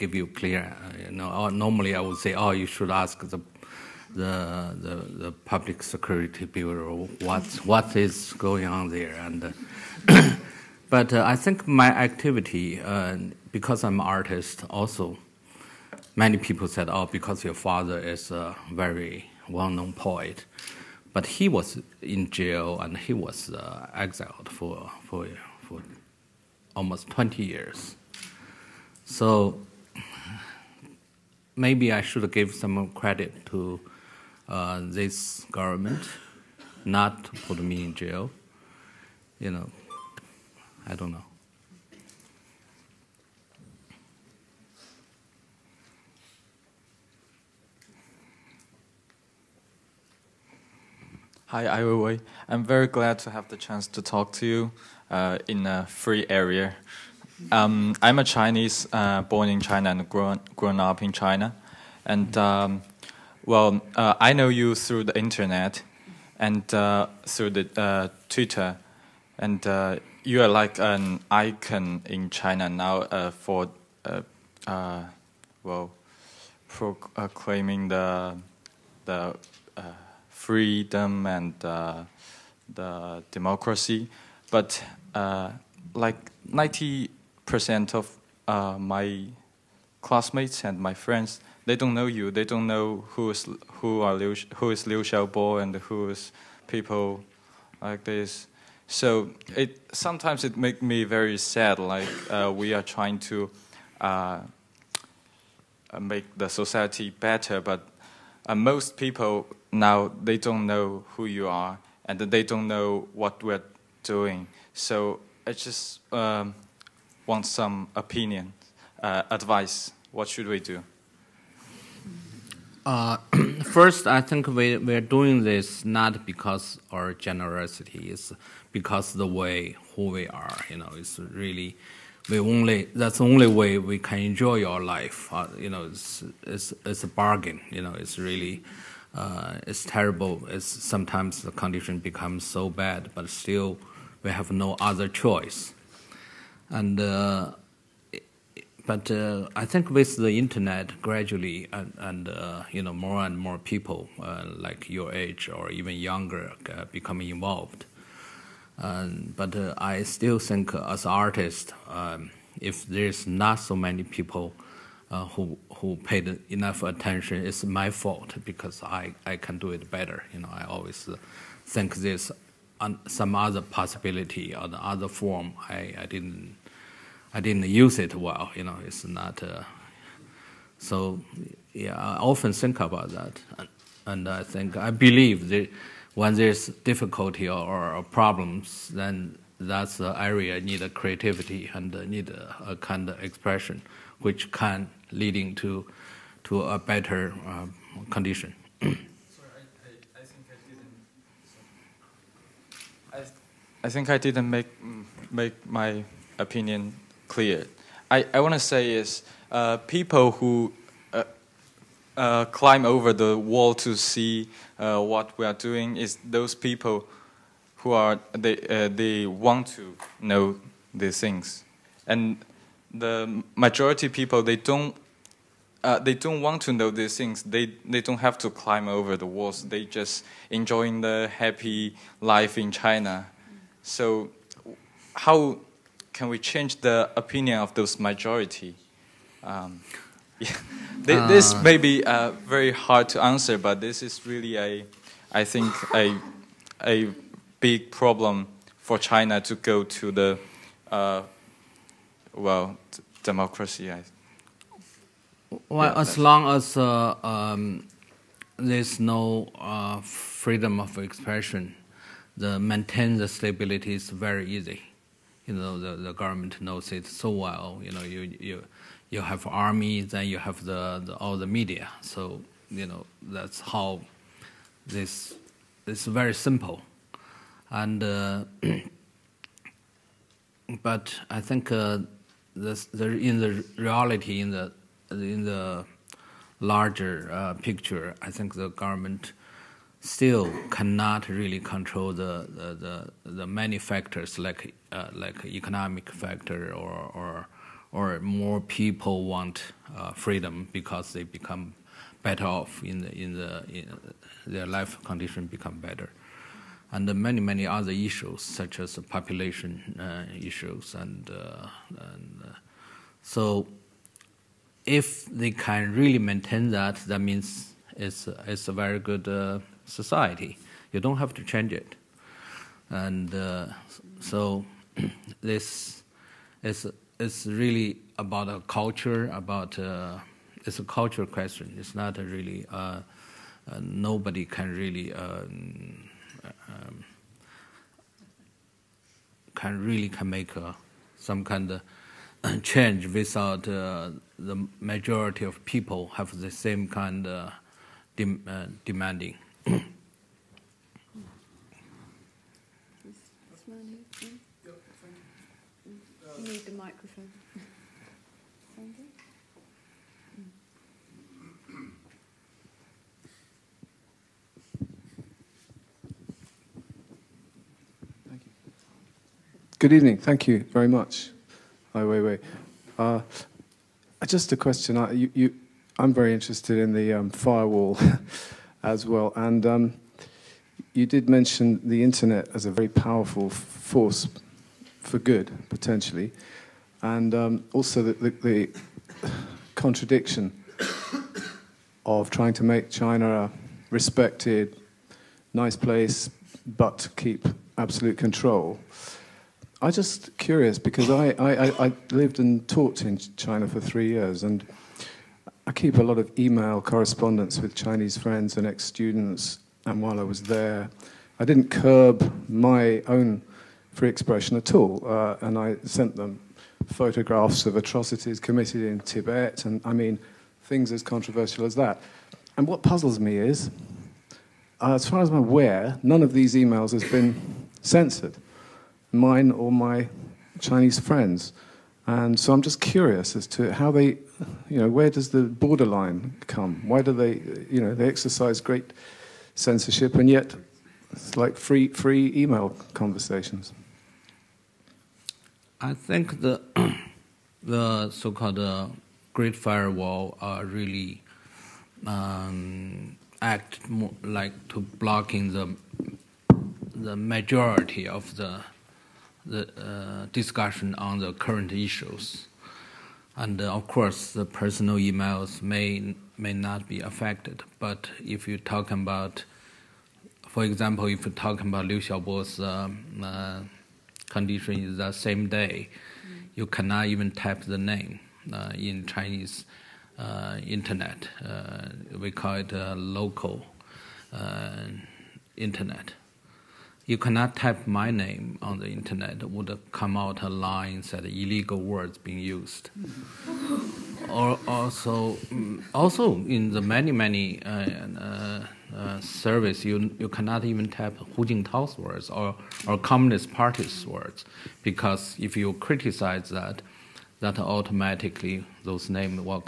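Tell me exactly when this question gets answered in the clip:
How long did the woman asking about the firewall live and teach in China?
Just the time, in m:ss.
6:43.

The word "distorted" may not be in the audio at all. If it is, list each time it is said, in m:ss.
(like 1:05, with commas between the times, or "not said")
not said.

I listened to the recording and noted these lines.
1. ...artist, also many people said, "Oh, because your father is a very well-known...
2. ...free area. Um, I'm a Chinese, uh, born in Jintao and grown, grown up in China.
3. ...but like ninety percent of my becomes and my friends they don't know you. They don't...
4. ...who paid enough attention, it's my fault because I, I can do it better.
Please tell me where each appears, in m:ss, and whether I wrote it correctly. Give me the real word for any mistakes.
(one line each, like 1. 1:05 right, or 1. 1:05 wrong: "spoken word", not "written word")
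1. 0:14 right
2. 0:55 wrong: "China", not "Jintao"
3. 1:24 wrong: "classmates", not "becomes"
4. 2:45 right.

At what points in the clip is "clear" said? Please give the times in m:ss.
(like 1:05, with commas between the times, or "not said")
0:00, 3:27.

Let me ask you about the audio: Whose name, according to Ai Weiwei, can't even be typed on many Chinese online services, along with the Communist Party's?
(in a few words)
Hu Jintao.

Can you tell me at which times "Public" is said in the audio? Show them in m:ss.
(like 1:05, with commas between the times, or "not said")
0:05.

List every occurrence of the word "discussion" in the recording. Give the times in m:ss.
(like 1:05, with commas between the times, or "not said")
7:40.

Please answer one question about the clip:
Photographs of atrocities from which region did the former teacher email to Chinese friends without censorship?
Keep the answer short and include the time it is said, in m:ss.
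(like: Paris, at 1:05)
Tibet, at 6:58.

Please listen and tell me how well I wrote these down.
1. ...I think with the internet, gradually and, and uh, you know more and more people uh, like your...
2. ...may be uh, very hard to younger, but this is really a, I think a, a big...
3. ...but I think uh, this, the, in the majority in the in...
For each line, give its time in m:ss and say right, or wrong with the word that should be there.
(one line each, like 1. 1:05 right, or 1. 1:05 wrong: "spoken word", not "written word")
1. 2:29 right
2. 4:01 wrong: "answer", not "younger"
3. 4:40 wrong: "reality", not "majority".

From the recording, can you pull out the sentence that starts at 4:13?
I, well, yeah, as long as uh, um, there's no uh, freedom of expression, the maintain the stability is very easy.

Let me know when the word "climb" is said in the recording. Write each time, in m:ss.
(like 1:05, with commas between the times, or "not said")
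3:32, 3:48.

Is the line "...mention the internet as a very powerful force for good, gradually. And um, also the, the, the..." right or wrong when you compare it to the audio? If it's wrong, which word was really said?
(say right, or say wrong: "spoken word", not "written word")
wrong: "potentially", not "gradually".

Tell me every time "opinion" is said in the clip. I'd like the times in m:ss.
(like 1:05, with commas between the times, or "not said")
1:57, 3:26, 3:57.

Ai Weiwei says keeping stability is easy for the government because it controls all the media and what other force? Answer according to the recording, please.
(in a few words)
army.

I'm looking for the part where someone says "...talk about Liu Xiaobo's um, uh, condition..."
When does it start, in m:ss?
7:51.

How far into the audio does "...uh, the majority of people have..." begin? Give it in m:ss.
5:43.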